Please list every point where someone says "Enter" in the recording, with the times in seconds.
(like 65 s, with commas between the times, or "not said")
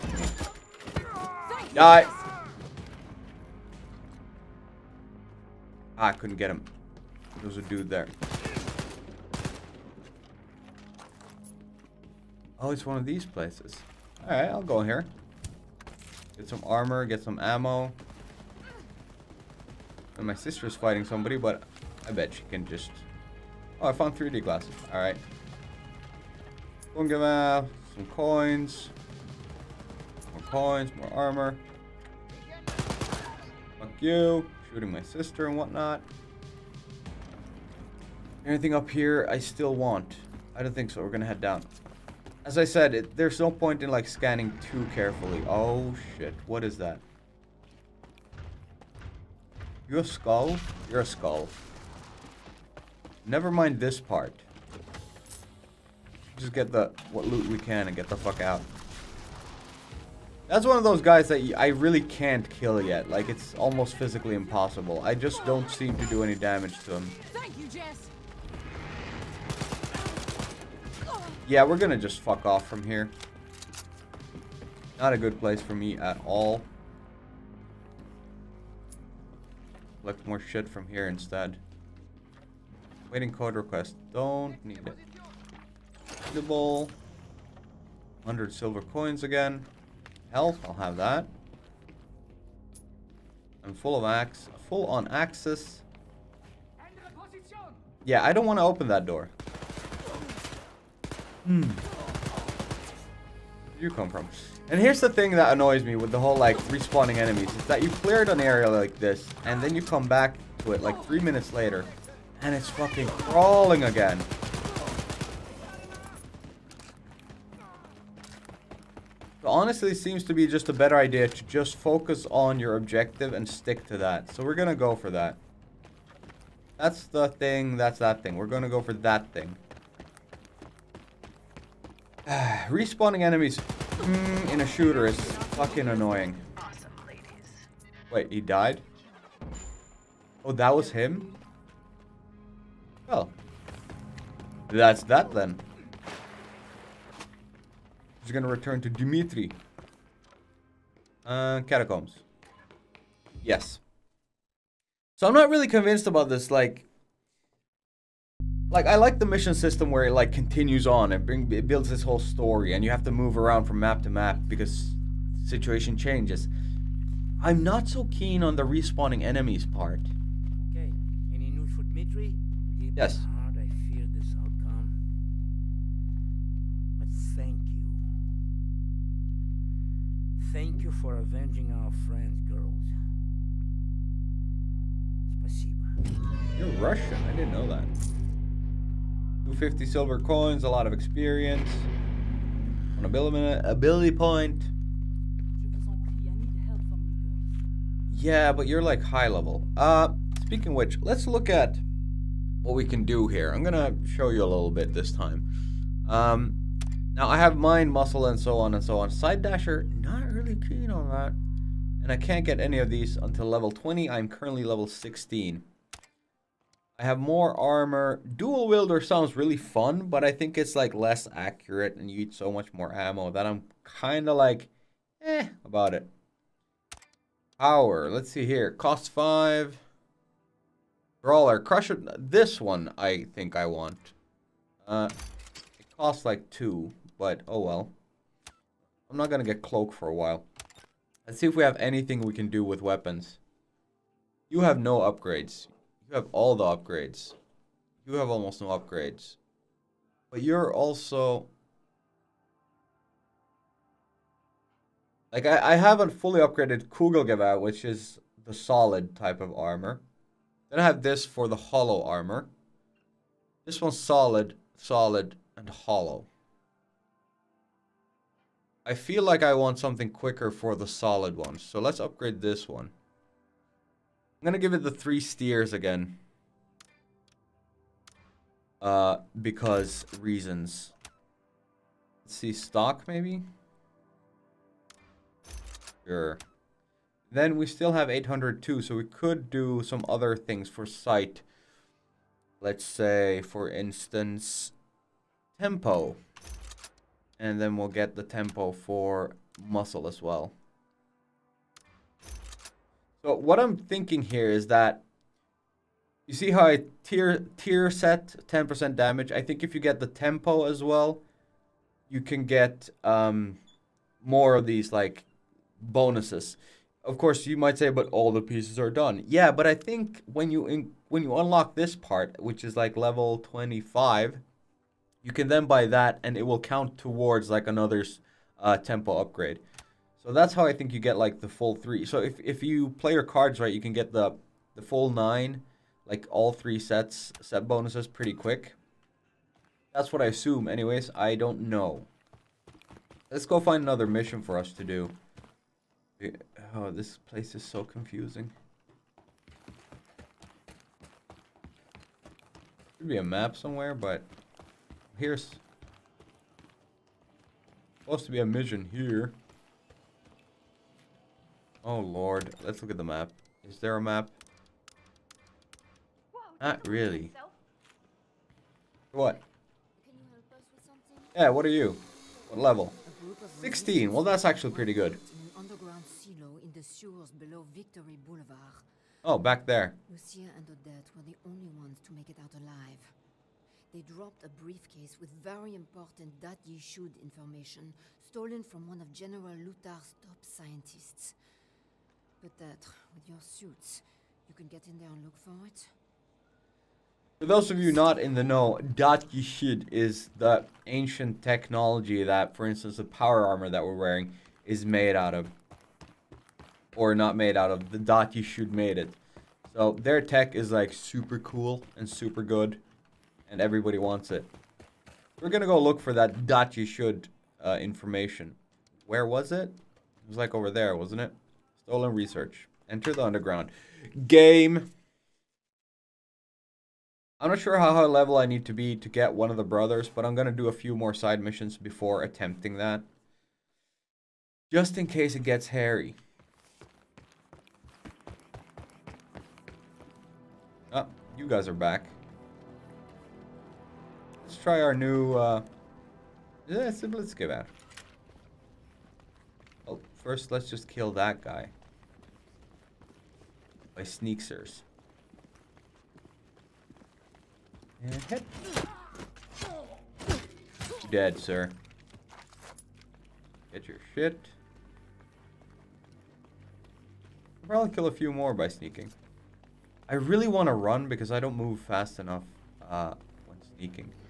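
422 s.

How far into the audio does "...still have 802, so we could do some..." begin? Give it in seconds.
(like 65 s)
287 s.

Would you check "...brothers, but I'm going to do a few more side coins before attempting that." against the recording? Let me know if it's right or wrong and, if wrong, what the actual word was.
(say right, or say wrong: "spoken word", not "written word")
wrong: "missions", not "coins".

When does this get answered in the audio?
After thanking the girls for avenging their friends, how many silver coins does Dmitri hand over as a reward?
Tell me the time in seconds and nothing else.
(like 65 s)
189 s.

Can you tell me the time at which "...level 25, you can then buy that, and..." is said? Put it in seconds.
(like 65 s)
322 s.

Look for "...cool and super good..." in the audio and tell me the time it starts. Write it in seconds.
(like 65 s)
411 s.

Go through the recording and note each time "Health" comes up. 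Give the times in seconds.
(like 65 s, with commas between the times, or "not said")
90 s.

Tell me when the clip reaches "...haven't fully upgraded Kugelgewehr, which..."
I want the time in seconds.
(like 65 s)
255 s.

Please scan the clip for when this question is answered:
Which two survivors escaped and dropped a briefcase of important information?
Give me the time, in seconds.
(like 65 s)
380 s.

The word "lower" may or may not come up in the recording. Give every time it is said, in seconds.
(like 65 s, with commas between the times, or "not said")
not said.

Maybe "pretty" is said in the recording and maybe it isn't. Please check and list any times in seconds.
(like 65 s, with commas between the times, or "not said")
338 s, 374 s.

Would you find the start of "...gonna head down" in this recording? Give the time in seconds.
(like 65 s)
41 s.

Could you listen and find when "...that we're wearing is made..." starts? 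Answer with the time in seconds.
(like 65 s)
403 s.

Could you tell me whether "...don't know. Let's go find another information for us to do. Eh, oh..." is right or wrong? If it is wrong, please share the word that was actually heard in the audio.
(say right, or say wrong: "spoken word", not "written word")
wrong: "mission", not "information".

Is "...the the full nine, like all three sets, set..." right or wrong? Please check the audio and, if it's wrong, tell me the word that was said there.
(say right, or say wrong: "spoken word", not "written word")
right.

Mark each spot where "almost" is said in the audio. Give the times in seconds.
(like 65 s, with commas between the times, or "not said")
63 s, 248 s.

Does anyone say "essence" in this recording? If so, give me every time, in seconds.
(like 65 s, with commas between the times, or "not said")
not said.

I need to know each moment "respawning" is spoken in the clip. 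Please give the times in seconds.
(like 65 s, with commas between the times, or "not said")
106 s, 132 s, 168 s.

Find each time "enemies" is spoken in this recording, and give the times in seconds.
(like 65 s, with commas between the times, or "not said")
107 s, 133 s, 169 s.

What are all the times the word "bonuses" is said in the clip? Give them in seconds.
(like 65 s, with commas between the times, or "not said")
315 s, 337 s.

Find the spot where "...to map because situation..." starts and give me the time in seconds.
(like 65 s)
164 s.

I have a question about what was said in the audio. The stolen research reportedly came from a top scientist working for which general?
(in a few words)
General Lothar.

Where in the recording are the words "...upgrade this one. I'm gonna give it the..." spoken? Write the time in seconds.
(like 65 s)
271 s.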